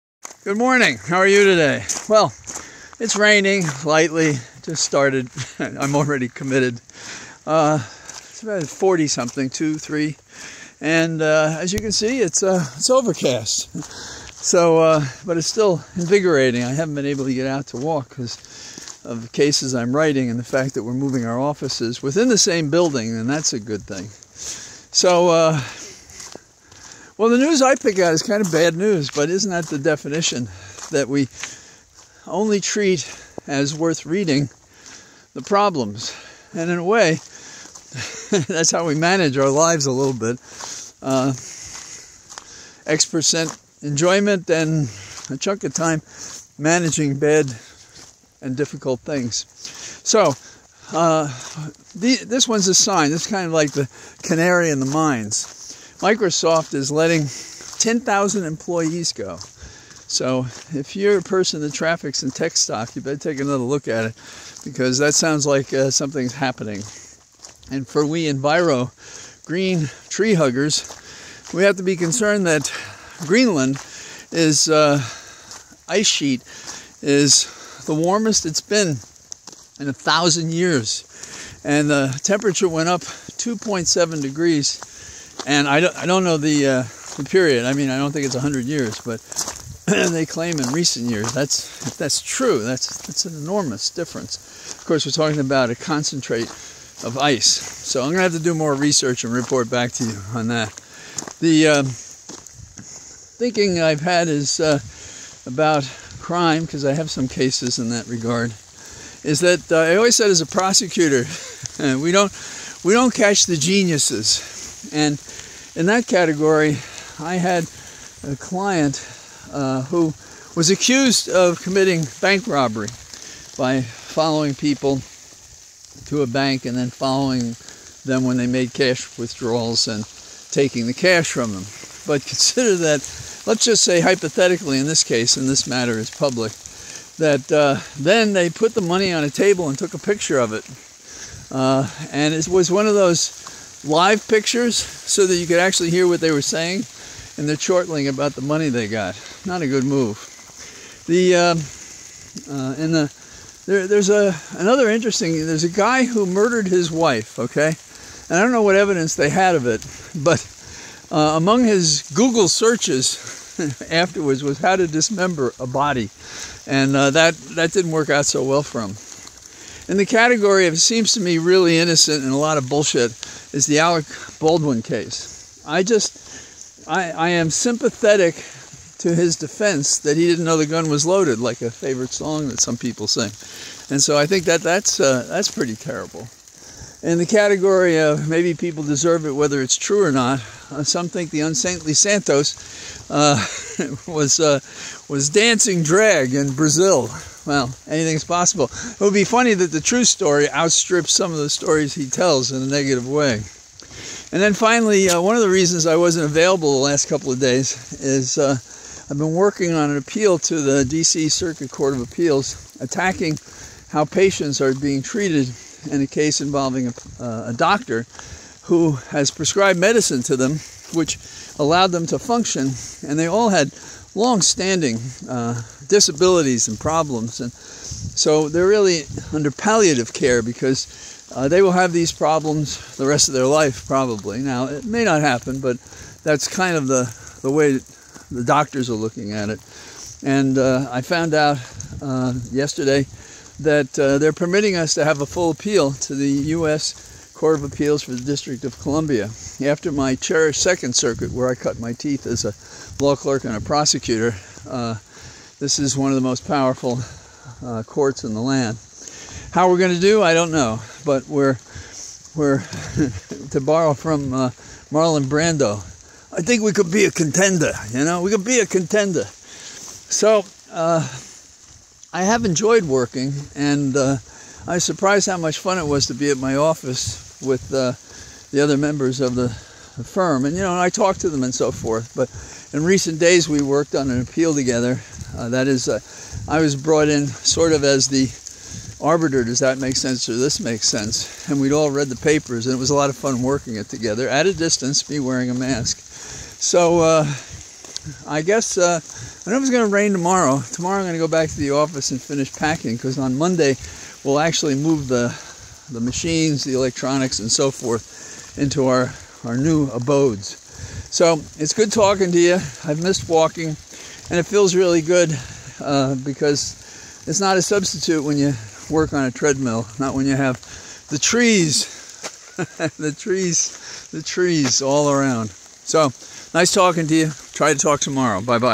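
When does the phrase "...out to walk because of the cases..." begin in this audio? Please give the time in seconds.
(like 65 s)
17 s.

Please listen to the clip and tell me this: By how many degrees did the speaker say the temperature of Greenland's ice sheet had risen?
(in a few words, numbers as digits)
2.7.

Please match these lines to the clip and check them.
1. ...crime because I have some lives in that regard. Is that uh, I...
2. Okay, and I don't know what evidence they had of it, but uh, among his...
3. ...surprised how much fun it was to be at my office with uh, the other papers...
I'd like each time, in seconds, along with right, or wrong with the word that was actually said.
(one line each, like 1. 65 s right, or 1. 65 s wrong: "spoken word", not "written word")
1. 106 s wrong: "cases", not "lives"
2. 157 s right
3. 274 s wrong: "members", not "papers".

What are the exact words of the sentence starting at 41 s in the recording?
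Uh, X percent enjoyment and a chunk of time managing bad and difficult things.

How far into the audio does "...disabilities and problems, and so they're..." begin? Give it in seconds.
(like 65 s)
225 s.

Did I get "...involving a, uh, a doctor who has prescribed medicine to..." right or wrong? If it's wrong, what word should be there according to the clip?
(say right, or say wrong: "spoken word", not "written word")
right.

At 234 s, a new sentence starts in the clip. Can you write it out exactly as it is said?
Now it may not happen, but that's kind of the the way the doctors are looking at it.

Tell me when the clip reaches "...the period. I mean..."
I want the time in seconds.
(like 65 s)
87 s.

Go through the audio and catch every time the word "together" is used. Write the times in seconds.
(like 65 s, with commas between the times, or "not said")
284 s, 293 s.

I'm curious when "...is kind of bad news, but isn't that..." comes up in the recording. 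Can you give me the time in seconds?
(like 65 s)
28 s.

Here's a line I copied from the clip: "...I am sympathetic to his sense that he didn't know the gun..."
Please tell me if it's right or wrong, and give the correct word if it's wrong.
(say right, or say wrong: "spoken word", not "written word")
wrong: "defense", not "sense".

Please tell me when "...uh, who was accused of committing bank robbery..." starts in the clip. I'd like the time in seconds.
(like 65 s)
119 s.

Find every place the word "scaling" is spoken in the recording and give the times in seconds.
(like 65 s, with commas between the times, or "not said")
not said.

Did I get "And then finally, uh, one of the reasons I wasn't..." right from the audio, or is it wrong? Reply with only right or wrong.
right.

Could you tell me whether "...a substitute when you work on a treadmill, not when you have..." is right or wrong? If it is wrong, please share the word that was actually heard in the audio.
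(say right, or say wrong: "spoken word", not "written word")
right.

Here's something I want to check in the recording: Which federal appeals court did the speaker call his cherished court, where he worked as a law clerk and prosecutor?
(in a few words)
Second Circuit.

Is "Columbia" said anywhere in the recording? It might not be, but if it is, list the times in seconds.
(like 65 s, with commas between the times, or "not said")
248 s.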